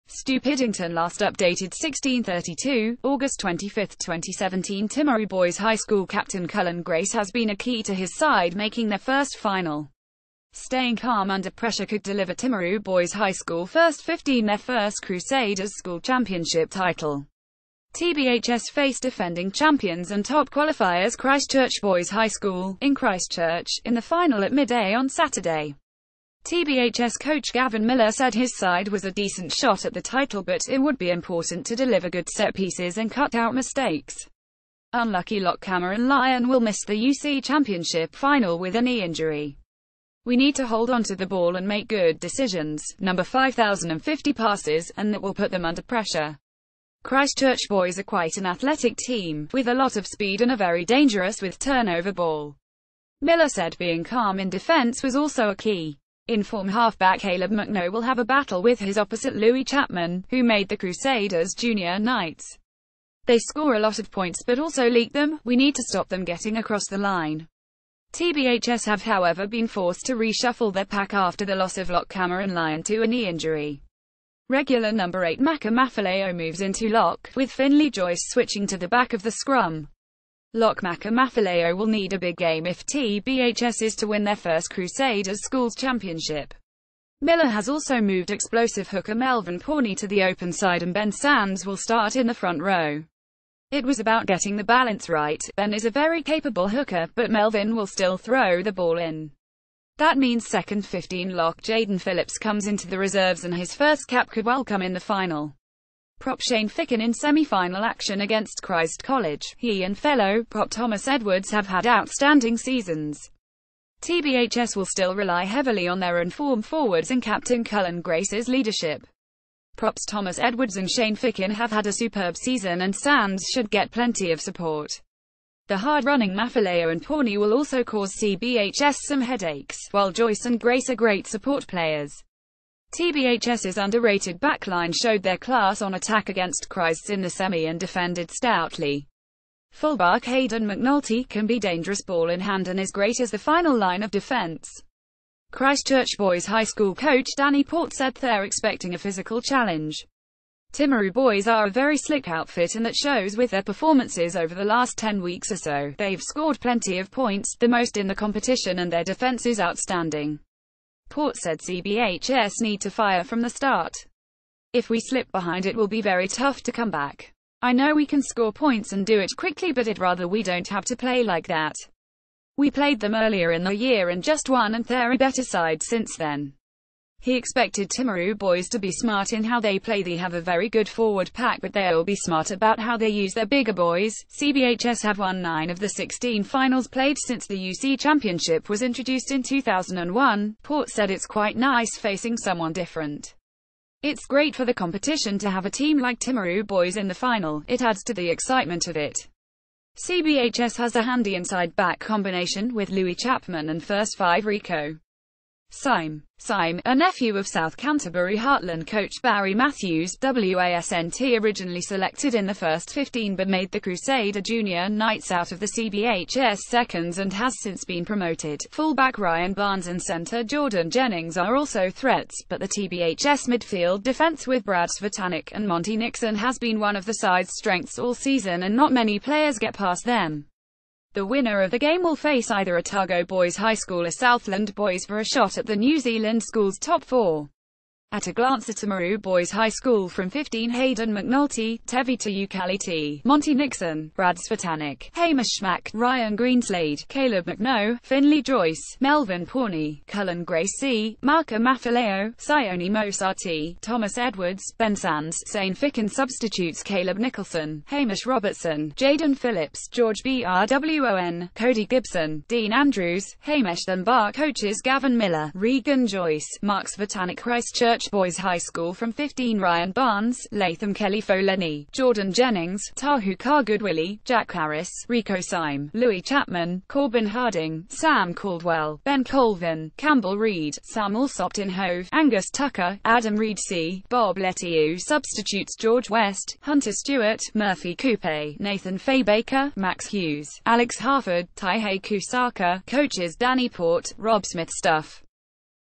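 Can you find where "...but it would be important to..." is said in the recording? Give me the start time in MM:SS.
00:30.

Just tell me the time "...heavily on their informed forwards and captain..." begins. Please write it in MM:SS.
01:55.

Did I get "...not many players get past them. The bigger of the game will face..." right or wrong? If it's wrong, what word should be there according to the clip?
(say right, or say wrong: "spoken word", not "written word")
wrong: "winner", not "bigger".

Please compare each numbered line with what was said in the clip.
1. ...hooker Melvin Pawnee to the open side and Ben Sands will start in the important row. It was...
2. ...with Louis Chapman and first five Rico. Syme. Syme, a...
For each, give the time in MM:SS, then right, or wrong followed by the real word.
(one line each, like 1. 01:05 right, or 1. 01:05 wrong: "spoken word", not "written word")
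1. 01:28 wrong: "front", not "important"
2. 03:22 right.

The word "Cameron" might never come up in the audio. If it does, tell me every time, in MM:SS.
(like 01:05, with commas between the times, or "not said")
00:35, 01:12.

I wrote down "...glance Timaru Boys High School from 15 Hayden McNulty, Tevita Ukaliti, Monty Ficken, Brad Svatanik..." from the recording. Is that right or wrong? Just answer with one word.
wrong.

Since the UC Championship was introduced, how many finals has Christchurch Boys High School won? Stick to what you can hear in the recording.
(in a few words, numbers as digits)
9.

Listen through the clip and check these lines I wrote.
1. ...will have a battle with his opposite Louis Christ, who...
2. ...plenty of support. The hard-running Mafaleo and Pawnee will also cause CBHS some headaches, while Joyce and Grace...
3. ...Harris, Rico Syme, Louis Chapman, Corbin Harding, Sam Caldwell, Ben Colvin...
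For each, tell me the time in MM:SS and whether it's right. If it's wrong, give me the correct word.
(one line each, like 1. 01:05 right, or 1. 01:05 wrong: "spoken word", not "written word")
1. 00:57 wrong: "Chapman", not "Christ"
2. 02:03 right
3. 04:34 right.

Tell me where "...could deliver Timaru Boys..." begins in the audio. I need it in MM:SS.
00:11.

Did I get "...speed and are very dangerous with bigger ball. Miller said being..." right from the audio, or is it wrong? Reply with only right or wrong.
wrong.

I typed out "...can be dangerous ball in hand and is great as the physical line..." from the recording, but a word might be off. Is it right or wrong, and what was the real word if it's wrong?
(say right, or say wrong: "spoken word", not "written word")
wrong: "final", not "physical".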